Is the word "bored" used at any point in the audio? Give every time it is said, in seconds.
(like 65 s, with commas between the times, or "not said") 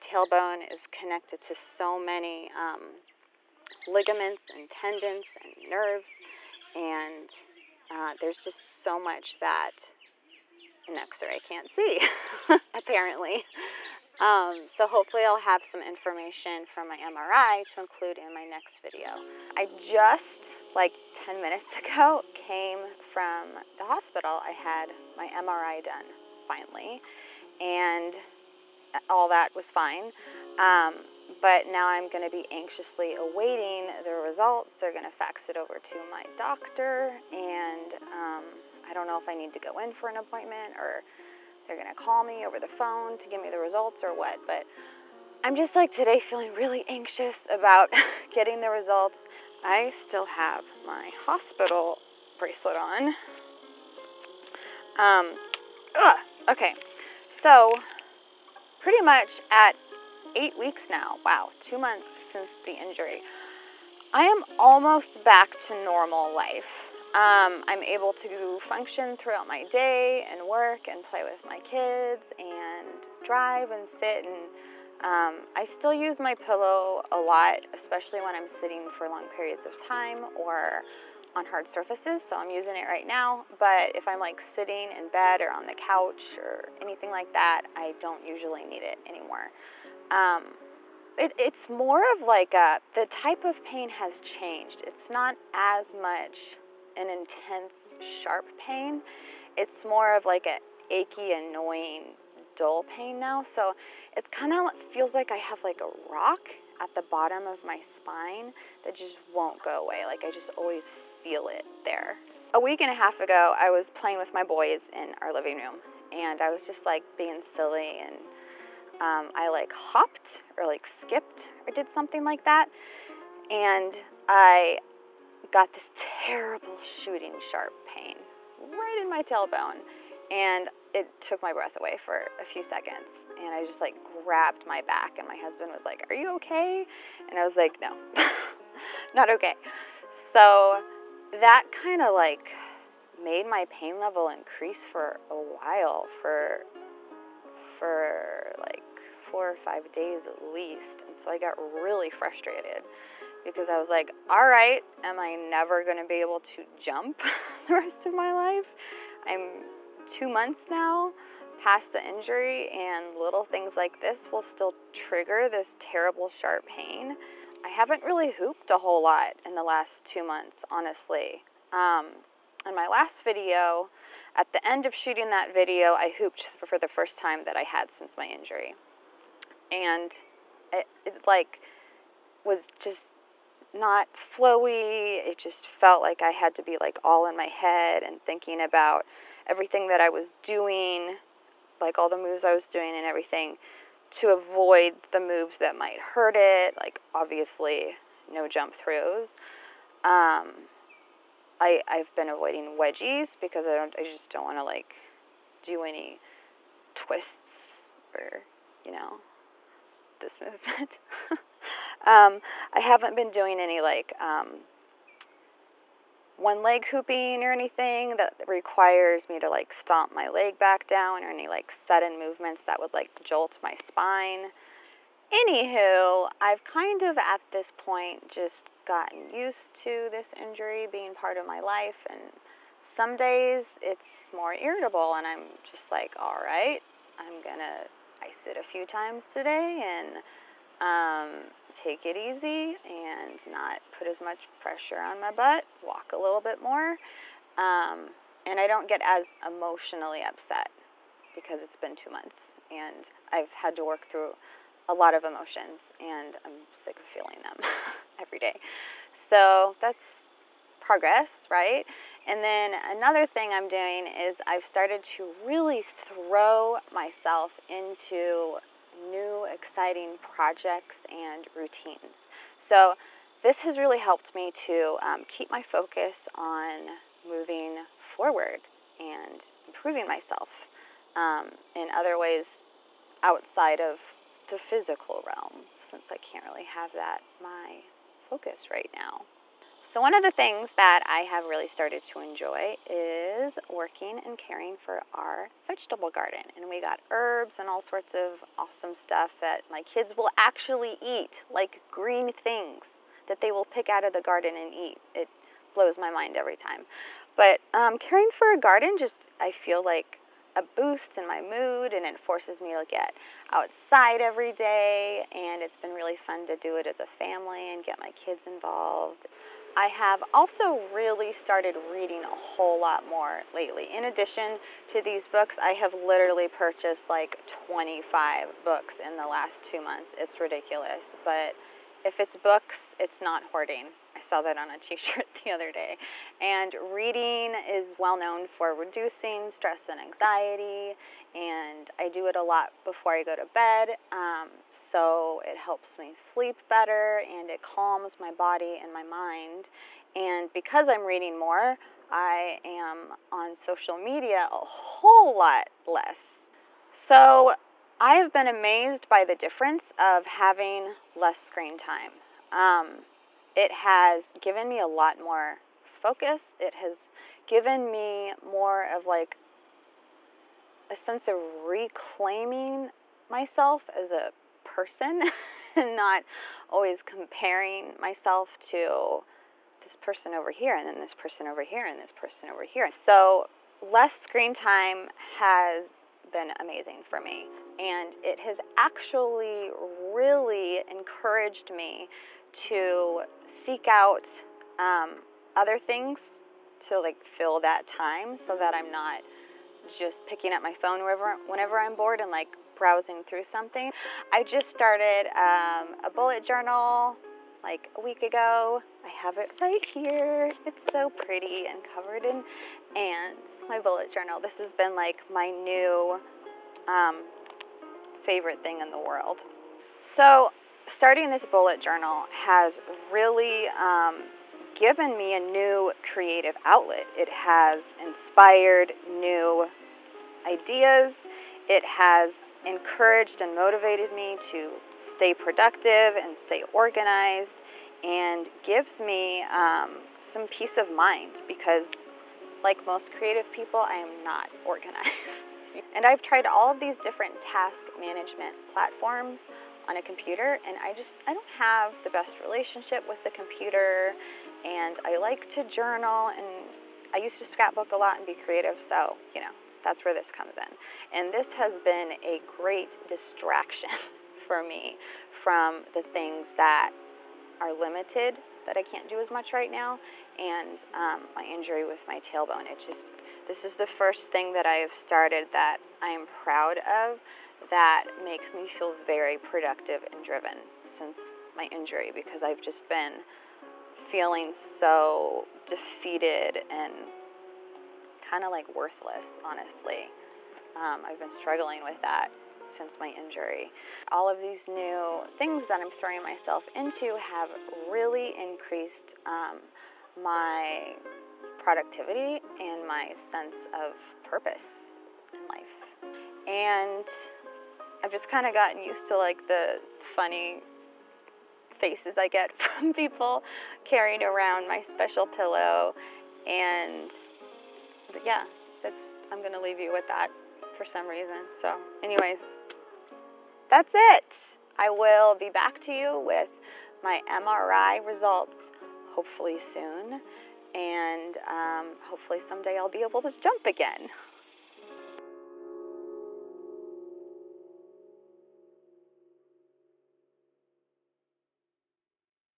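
401 s.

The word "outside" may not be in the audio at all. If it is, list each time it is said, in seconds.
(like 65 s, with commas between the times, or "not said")
283 s, 313 s.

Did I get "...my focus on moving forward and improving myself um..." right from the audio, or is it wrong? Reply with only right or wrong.
right.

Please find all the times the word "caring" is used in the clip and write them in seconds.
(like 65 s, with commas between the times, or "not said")
294 s, 307 s.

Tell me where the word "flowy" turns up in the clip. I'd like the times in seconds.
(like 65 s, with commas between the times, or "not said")
184 s.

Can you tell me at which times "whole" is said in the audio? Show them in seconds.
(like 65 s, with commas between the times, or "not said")
168 s, 322 s, 354 s.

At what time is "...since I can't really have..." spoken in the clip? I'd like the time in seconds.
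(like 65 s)
285 s.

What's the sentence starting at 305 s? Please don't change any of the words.
It blows my mind every time.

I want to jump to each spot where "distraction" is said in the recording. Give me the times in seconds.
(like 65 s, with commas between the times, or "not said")
463 s.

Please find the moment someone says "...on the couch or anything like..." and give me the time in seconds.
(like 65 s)
85 s.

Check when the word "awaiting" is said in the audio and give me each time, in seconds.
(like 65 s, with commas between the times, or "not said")
33 s.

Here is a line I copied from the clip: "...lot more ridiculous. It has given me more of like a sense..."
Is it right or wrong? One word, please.
wrong.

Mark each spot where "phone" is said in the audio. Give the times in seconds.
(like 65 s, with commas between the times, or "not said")
42 s, 400 s.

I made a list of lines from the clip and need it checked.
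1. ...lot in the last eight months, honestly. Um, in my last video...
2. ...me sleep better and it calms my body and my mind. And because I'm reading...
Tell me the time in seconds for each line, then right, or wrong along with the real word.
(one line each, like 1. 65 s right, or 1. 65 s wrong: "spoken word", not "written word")
1. 169 s wrong: "two", not "eight"
2. 345 s right.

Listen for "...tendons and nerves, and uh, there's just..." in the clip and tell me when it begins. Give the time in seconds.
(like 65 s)
4 s.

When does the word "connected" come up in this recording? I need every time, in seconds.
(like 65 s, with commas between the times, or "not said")
0 s.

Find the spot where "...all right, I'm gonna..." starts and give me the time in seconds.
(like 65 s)
236 s.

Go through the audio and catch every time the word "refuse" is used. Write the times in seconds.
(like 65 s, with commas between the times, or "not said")
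not said.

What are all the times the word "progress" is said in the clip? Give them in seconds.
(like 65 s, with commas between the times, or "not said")
260 s.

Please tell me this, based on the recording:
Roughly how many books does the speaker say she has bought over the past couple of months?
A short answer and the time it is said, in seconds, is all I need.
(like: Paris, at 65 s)
25, at 327 s.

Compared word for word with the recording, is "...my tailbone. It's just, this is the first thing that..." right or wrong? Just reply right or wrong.
right.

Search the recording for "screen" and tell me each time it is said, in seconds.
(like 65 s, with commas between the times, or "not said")
361 s, 384 s.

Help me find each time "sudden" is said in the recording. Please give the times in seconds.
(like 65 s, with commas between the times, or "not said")
221 s.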